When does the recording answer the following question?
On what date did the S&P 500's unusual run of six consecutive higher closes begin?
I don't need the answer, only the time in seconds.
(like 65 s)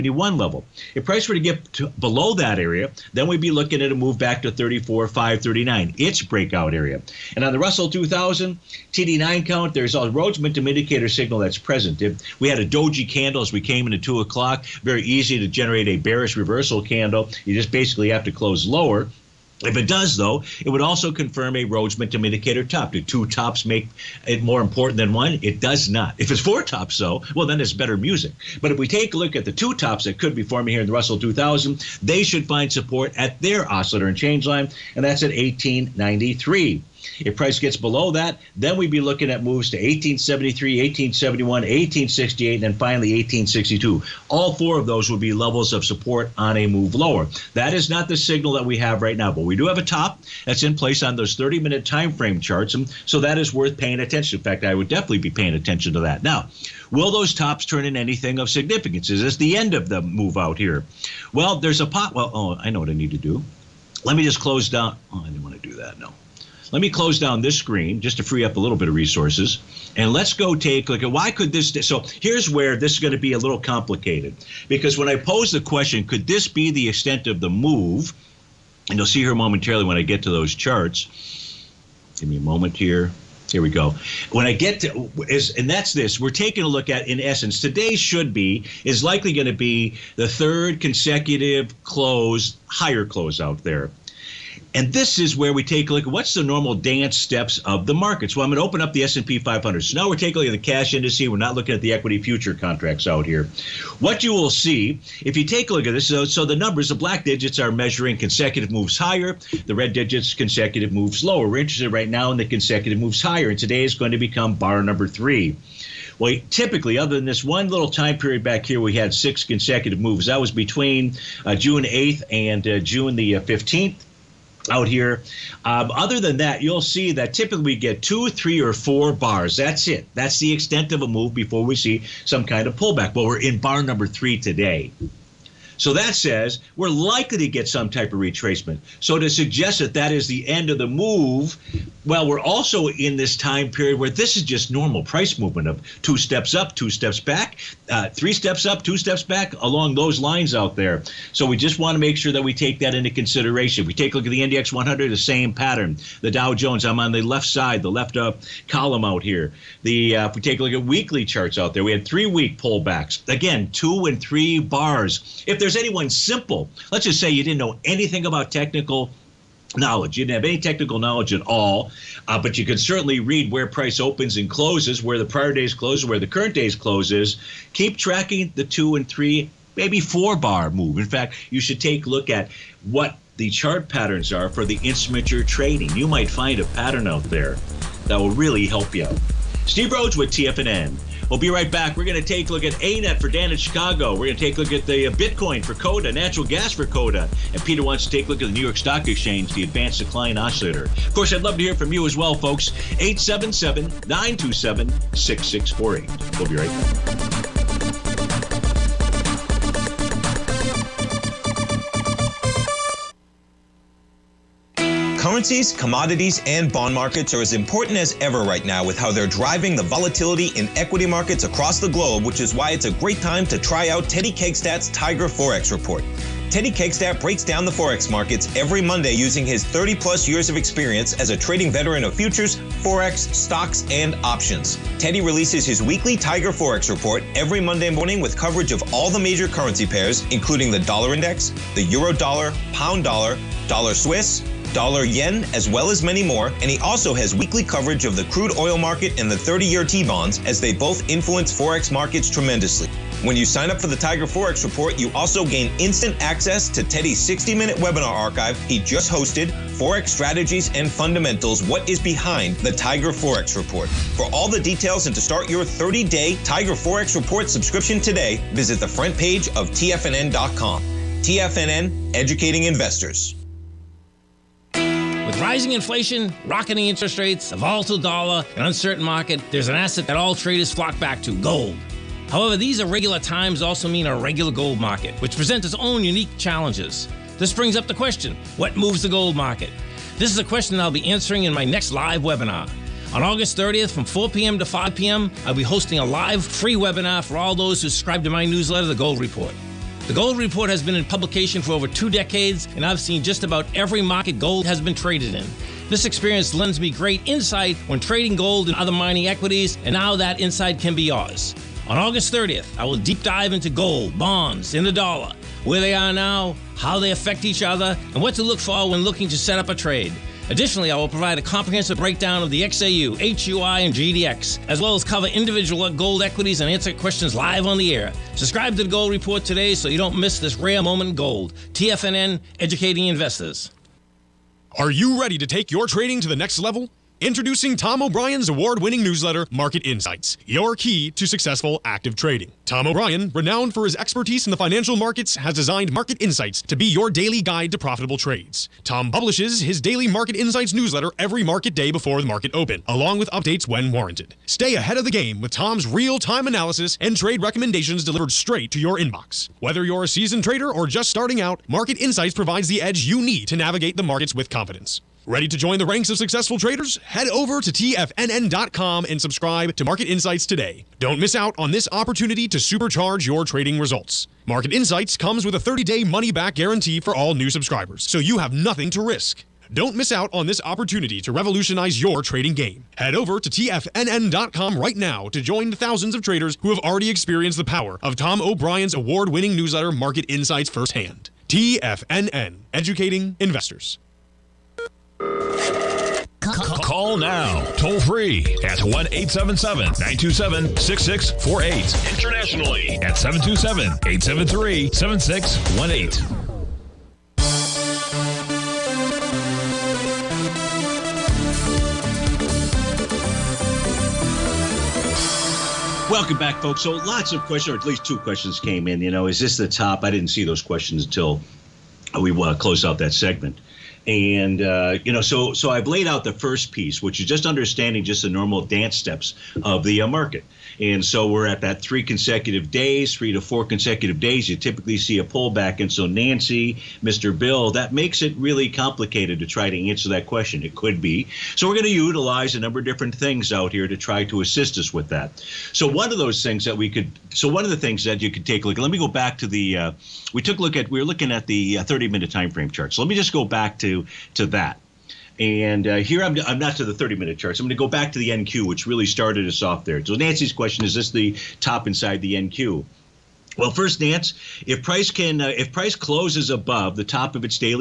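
121 s.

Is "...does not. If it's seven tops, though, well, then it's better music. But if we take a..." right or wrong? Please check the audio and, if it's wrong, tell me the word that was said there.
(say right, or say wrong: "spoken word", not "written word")
wrong: "four", not "seven".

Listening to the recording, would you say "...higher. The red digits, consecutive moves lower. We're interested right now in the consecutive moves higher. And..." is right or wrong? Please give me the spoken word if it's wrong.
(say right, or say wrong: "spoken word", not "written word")
right.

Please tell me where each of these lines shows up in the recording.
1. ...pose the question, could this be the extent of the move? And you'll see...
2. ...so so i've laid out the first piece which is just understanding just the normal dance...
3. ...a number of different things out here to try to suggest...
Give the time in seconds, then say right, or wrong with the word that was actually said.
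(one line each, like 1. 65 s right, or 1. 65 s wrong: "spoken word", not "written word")
1. 75 s right
2. 425 s right
3. 442 s wrong: "assist", not "suggest".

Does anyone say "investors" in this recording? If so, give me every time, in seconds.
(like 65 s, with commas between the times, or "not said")
272 s, 333 s, 393 s.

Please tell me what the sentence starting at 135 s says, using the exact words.
So that says we're likely to get some type of retracement.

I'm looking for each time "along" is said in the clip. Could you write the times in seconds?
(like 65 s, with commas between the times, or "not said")
149 s, 352 s.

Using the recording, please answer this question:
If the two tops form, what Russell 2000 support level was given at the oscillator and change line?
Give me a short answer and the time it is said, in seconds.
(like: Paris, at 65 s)
1893, at 35 s.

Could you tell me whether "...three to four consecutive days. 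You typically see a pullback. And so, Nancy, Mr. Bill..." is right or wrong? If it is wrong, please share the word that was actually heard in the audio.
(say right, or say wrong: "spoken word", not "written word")
right.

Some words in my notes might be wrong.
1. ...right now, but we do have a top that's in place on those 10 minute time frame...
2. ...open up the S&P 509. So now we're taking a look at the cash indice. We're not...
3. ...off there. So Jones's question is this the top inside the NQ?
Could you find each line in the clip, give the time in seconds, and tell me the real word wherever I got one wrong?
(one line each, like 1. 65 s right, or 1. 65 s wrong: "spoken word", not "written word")
1. 49 s wrong: "30", not "10"
2. 98 s wrong: "500", not "509"
3. 459 s wrong: "Nancy", not "Jones".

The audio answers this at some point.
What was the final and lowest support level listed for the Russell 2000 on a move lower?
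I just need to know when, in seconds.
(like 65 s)
43 s.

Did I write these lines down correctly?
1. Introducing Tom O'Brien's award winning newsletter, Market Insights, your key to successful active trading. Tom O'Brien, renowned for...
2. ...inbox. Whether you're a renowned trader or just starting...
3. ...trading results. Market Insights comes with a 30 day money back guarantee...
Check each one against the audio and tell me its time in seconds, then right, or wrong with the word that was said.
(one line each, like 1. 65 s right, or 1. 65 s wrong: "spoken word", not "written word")
1. 337 s right
2. 358 s wrong: "seasoned", not "renowned"
3. 373 s right.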